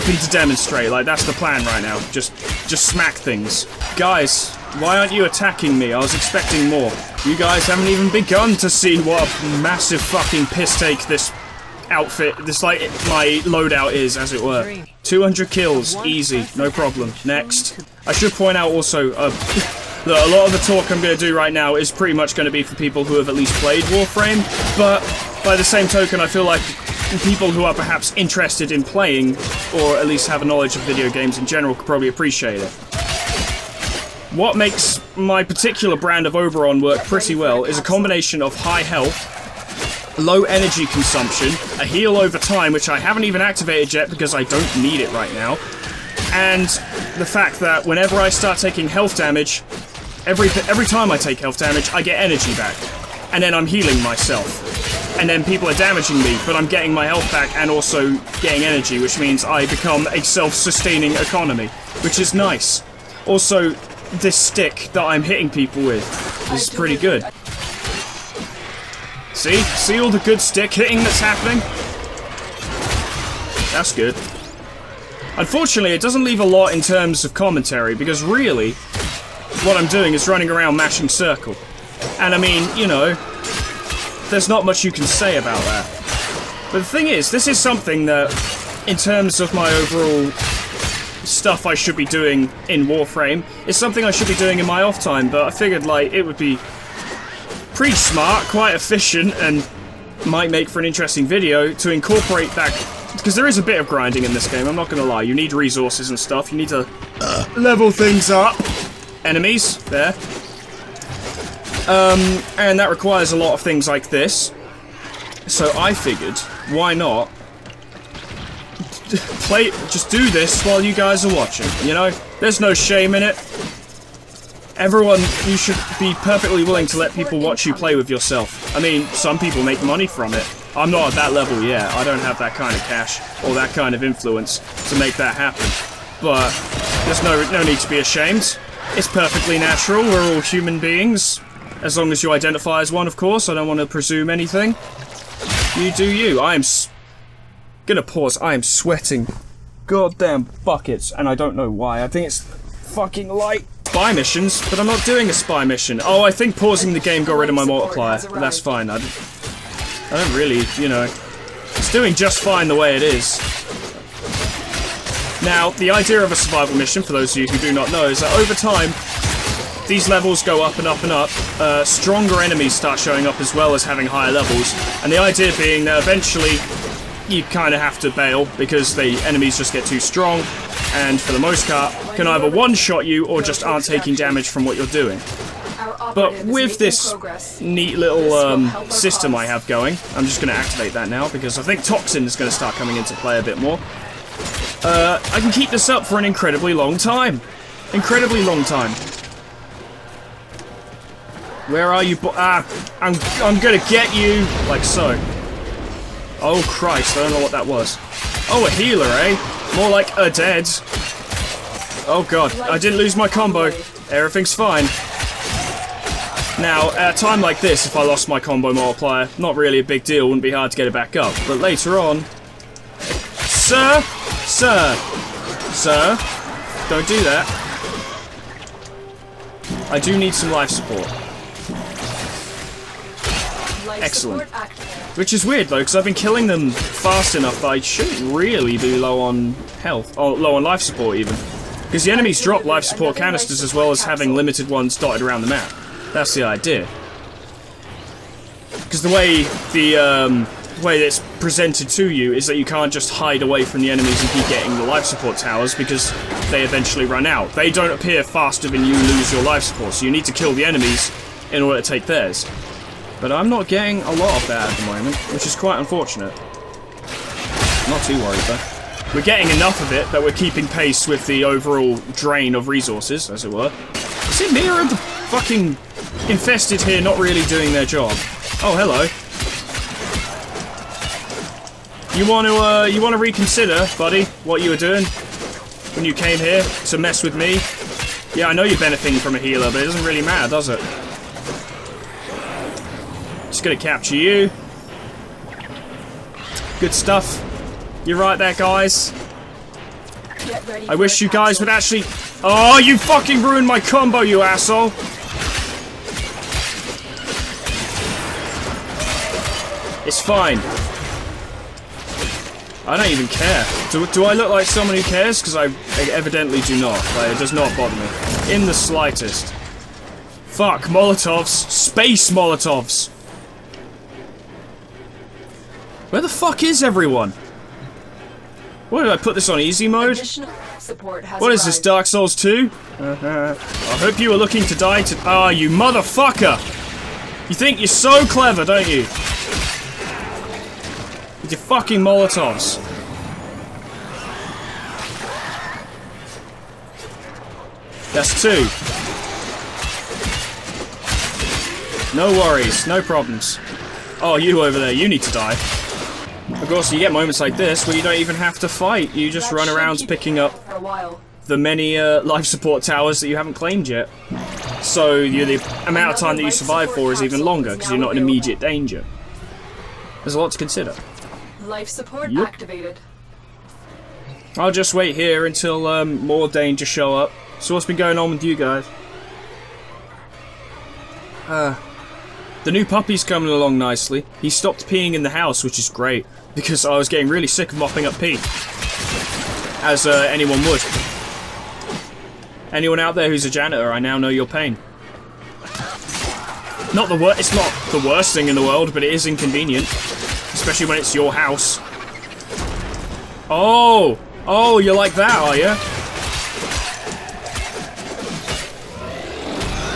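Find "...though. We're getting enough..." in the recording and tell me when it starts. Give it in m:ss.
4:28.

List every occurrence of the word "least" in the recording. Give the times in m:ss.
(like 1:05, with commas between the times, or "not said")
0:23, 0:30.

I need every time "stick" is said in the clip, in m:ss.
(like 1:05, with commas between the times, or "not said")
1:04, 1:10.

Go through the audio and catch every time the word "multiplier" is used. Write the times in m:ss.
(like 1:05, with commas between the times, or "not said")
2:37, 3:38.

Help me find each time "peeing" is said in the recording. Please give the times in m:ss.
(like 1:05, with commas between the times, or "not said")
6:24.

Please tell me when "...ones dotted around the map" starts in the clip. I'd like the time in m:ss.
4:04.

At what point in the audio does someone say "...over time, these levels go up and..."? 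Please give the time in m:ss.
2:48.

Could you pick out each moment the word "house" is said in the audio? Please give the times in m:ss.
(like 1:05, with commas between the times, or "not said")
6:25, 6:41.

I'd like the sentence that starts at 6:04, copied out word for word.
So you, the amount of time that you survive for is even longer because you're not in immediate danger.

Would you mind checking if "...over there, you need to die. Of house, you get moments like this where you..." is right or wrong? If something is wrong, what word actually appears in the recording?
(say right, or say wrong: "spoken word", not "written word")
wrong: "course", not "house".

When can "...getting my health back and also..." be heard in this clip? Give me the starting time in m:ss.
0:56.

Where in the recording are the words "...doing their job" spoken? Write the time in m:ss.
4:37.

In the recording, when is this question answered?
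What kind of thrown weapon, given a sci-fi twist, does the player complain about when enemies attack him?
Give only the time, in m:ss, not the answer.
5:21.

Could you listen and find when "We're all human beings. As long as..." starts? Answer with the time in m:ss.
2:20.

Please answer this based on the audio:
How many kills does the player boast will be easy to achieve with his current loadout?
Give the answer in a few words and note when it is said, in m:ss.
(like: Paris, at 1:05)
200, at 0:15.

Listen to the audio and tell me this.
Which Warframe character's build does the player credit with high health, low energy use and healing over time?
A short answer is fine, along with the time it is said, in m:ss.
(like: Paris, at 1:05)
Oberon, at 0:36.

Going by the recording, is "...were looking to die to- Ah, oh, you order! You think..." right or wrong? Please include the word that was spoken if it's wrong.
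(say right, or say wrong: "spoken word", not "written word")
wrong: "motherfucker", not "order".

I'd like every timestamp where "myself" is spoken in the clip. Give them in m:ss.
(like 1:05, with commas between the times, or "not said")
0:54.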